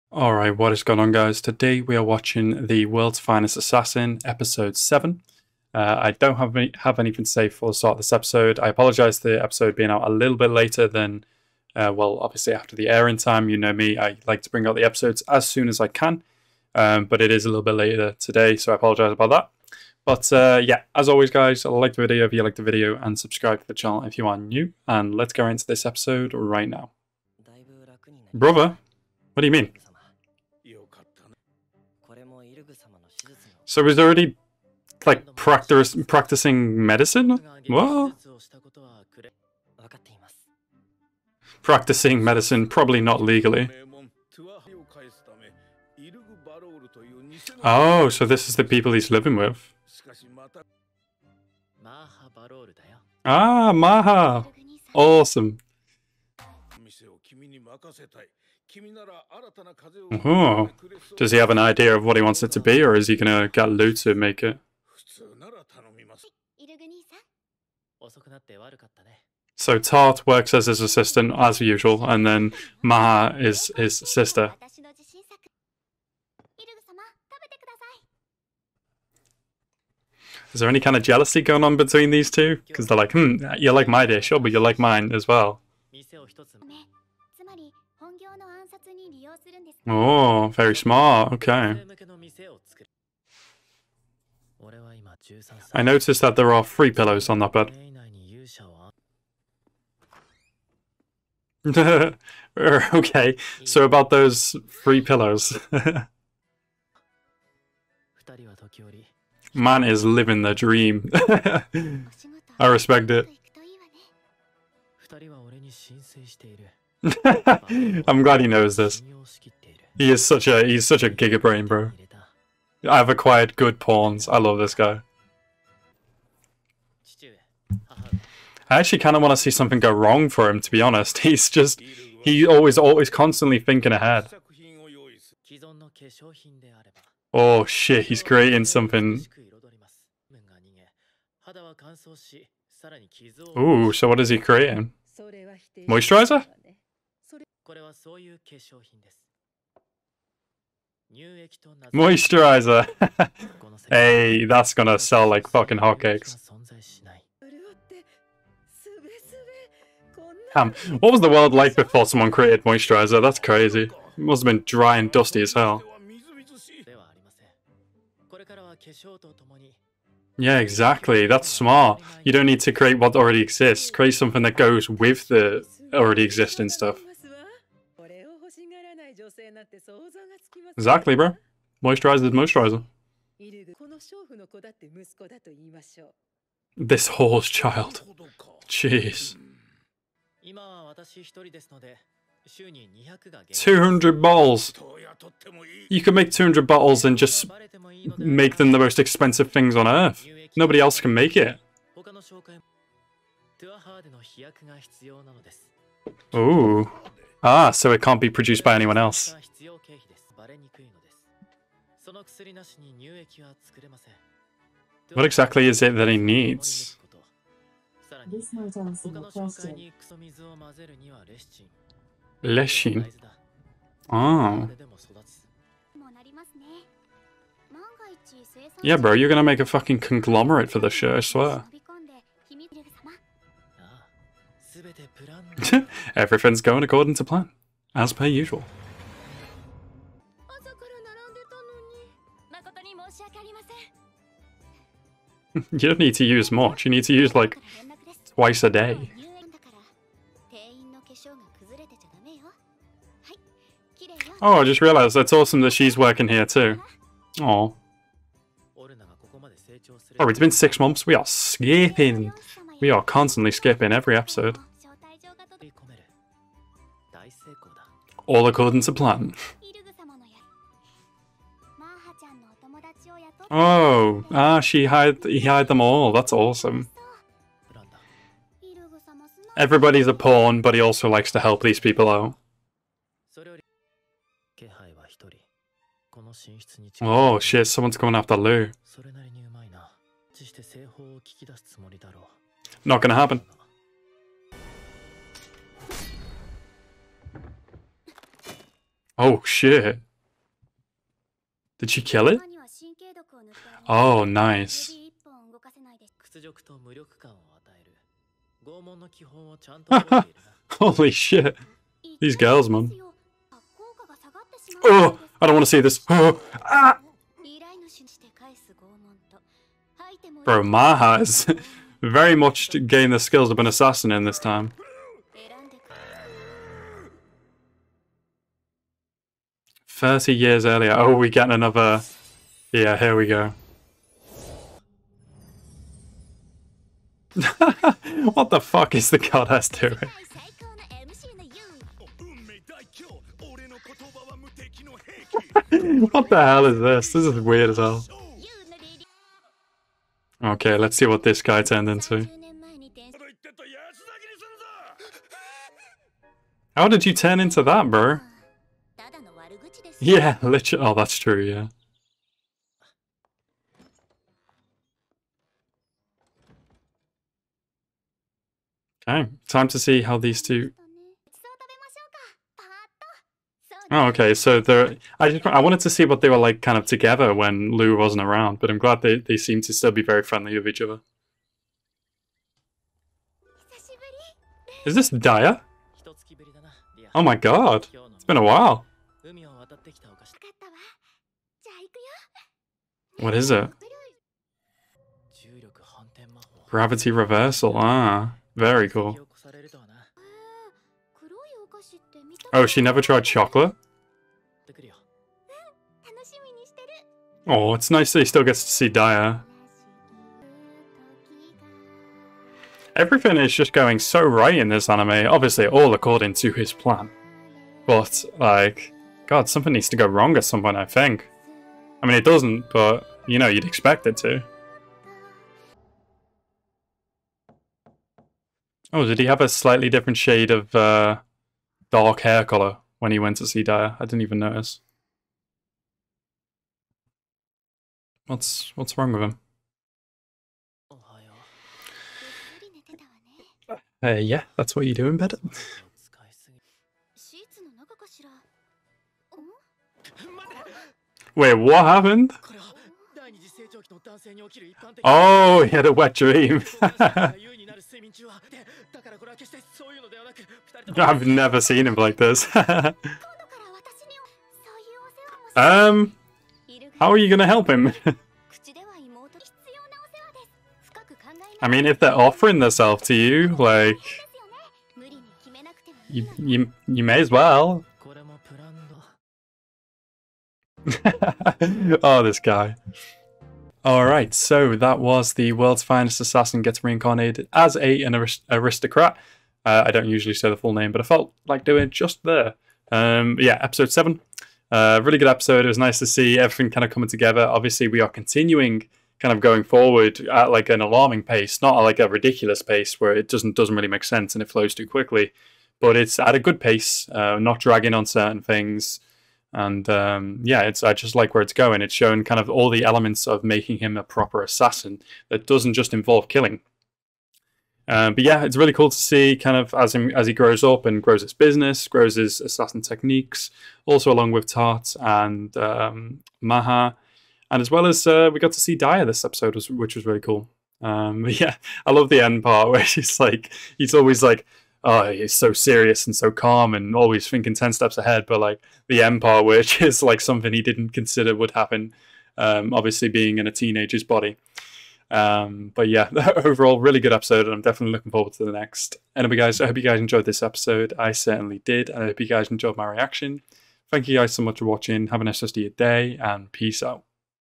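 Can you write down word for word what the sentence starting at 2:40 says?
Damn, what was the world like before someone created moisturizer?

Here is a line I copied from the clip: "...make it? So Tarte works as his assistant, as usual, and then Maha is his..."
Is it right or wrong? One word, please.
right.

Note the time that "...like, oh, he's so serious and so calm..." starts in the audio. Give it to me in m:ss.
8:54.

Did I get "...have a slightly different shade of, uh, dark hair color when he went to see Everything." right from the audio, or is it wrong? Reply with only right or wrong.
wrong.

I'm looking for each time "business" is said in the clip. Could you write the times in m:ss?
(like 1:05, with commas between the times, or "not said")
8:41.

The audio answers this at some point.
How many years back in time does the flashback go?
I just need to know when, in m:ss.
5:29.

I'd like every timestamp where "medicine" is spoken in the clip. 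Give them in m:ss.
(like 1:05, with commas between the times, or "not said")
0:36, 0:42.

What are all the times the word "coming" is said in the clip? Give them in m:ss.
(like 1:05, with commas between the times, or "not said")
4:47, 8:16.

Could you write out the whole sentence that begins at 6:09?
Okay, time to see how these two Oh, okay.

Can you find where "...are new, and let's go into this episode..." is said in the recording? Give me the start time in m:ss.
0:24.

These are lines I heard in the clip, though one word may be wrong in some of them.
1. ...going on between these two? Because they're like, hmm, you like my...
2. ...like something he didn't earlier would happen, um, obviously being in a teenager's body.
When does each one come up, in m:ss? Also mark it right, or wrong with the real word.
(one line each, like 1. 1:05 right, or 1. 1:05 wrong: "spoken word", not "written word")
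1. 1:21 right
2. 9:00 wrong: "consider", not "earlier".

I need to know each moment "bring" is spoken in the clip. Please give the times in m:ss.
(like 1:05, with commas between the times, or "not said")
0:14.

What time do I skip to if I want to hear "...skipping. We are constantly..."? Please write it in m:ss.
4:21.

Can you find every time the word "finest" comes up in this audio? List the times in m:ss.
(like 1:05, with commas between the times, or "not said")
0:03, 8:05.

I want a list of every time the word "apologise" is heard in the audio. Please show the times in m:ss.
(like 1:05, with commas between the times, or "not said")
0:08, 0:18.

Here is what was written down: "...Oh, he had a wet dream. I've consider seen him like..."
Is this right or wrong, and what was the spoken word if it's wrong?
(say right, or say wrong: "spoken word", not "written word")
wrong: "never", not "consider".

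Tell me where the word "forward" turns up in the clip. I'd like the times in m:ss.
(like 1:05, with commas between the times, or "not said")
8:19, 9:08.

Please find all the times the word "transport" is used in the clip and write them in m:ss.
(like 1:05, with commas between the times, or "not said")
not said.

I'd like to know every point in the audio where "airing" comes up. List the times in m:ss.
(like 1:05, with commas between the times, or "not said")
0:12.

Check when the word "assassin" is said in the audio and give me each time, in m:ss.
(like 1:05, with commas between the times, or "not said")
0:03, 5:23, 8:06, 8:34, 8:42.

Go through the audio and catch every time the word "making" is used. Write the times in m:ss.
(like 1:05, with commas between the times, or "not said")
8:33.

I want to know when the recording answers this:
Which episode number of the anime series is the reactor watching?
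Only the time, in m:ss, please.
0:04.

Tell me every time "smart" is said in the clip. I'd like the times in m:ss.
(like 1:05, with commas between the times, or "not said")
1:30, 2:51.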